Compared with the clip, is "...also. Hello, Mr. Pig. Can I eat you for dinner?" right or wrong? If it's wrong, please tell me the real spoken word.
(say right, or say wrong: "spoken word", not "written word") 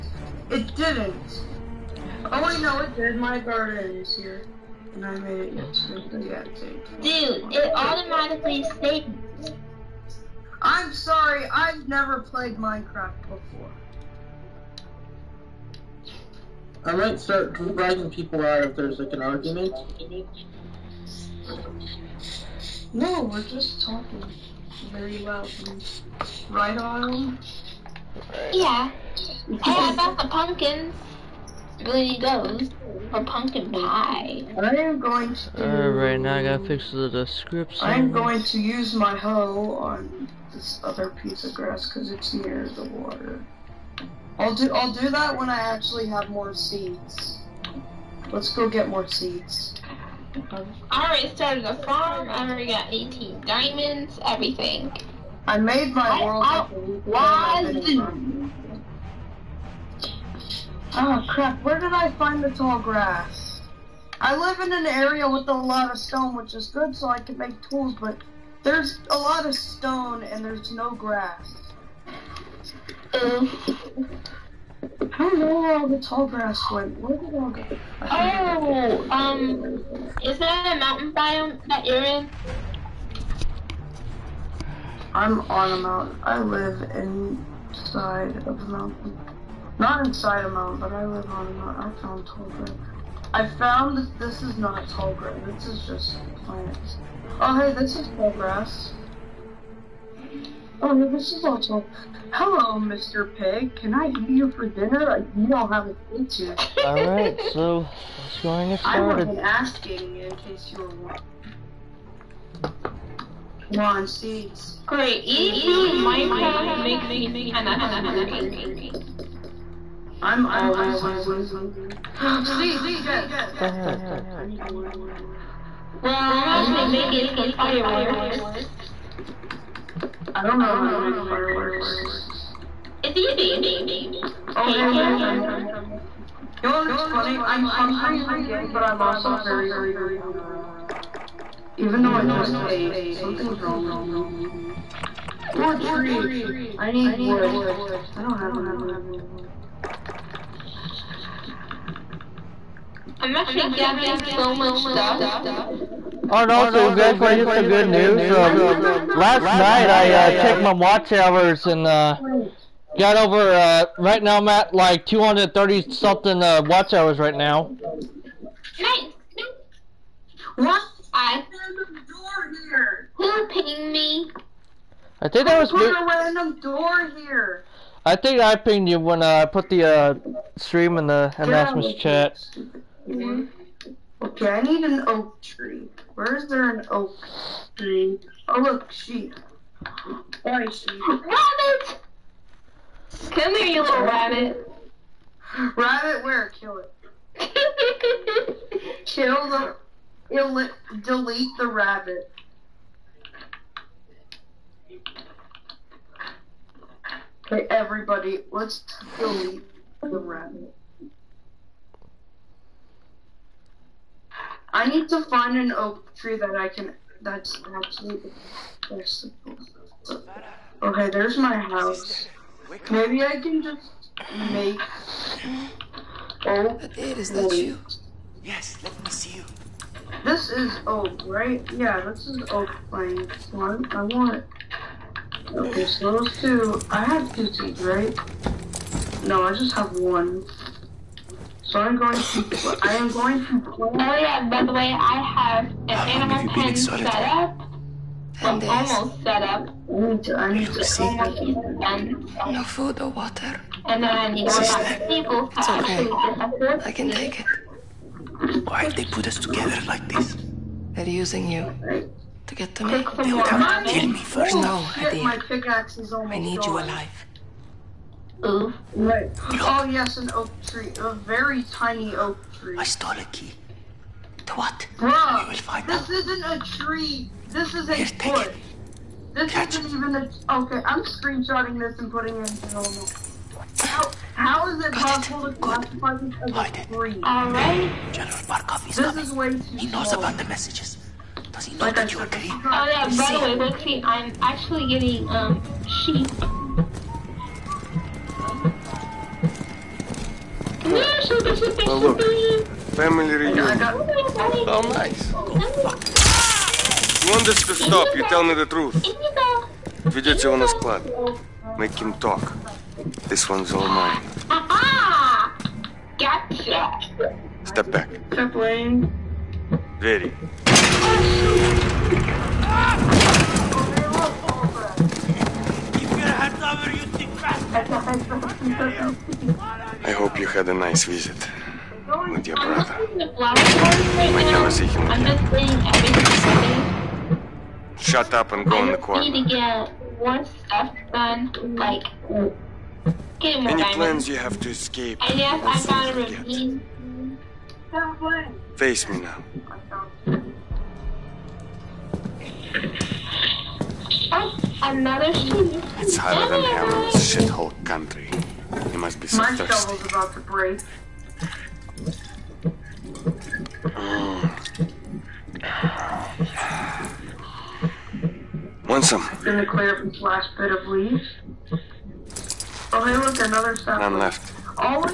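right.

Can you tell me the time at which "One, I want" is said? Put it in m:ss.
3:53.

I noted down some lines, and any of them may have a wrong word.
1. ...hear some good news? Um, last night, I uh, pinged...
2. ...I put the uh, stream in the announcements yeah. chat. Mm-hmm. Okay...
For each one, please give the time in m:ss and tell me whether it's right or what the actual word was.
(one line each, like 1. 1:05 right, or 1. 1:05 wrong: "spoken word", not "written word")
1. 2:37 wrong: "checked", not "pinged"
2. 2:59 right.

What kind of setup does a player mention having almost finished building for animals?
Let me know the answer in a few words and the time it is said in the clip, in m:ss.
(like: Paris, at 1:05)
Animal pen, at 4:06.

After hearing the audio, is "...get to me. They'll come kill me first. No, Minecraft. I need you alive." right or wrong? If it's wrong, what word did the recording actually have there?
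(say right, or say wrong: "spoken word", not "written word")
wrong: "Eddie", not "Minecraft".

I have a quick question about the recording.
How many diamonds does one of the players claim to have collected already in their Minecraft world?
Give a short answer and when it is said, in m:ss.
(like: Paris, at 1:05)
18, at 0:52.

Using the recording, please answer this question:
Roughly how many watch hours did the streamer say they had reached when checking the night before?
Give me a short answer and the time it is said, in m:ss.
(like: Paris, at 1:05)
230, at 2:45.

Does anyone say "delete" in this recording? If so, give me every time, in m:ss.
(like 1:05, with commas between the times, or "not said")
3:21, 3:29.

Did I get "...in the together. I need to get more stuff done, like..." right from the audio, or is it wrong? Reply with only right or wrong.
wrong.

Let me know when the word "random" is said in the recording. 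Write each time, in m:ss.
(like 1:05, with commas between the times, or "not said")
2:56.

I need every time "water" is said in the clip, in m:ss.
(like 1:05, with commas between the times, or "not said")
0:42, 4:13.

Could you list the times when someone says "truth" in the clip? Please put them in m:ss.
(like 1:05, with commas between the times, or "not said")
5:08.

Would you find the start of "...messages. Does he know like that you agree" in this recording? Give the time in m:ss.
4:50.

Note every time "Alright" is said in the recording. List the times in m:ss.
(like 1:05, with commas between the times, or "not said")
0:35, 4:47.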